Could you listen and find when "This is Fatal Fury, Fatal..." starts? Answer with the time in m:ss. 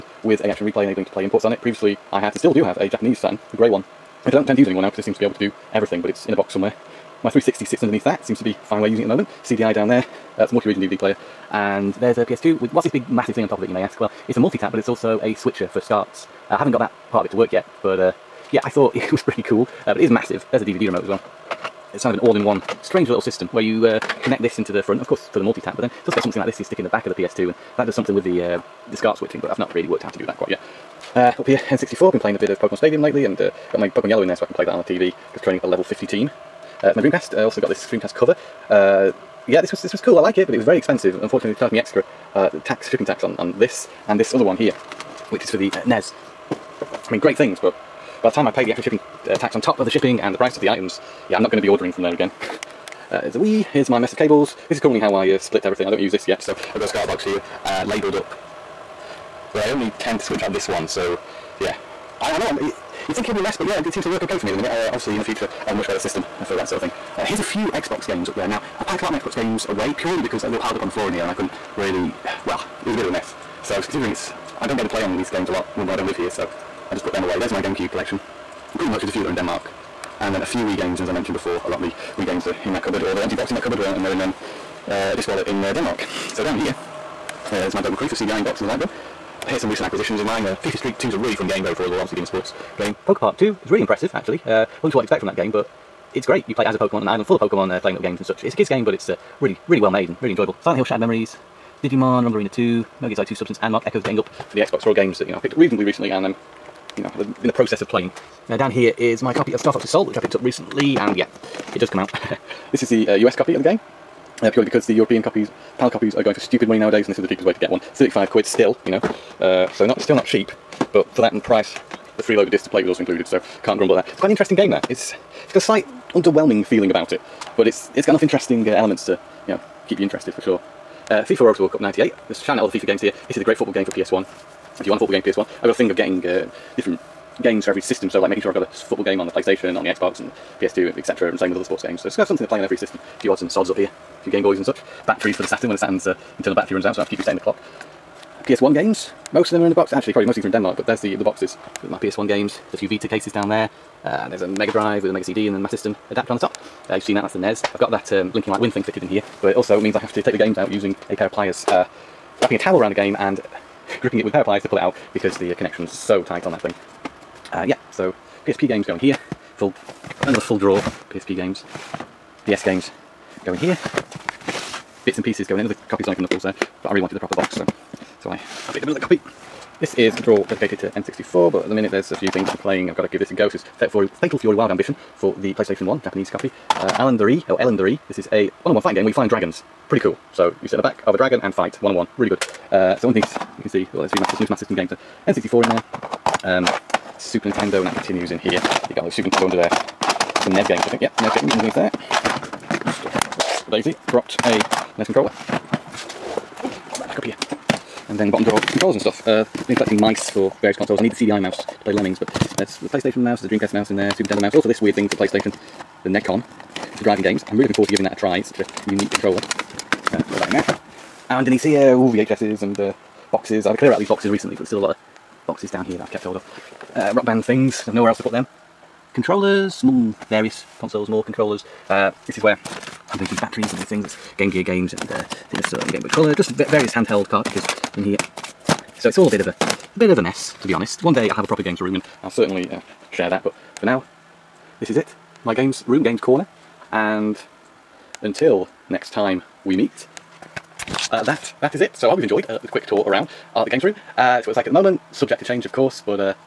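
3:03.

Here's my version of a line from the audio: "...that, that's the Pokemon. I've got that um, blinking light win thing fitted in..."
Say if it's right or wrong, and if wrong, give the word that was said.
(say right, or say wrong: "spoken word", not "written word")
wrong: "NES", not "Pokemon".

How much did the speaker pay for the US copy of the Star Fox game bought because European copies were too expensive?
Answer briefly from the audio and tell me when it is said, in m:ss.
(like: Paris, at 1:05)
35 quid, at 1:57.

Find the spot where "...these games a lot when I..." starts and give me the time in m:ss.
1:15.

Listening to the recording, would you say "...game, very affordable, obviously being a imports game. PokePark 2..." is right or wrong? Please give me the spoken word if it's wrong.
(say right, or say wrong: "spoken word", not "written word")
wrong: "sports", not "imports".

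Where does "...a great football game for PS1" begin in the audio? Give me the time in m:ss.
2:13.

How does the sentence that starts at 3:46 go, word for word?
Uh, rock band things, I've nowhere else to put them.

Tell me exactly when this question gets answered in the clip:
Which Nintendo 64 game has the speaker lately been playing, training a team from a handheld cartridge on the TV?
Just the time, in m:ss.
0:32.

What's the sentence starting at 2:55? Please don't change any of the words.
Another copy of Sonic & Knuckles there.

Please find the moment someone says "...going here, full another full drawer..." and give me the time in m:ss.
2:48.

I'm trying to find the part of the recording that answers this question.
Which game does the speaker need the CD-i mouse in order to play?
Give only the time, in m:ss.
3:31.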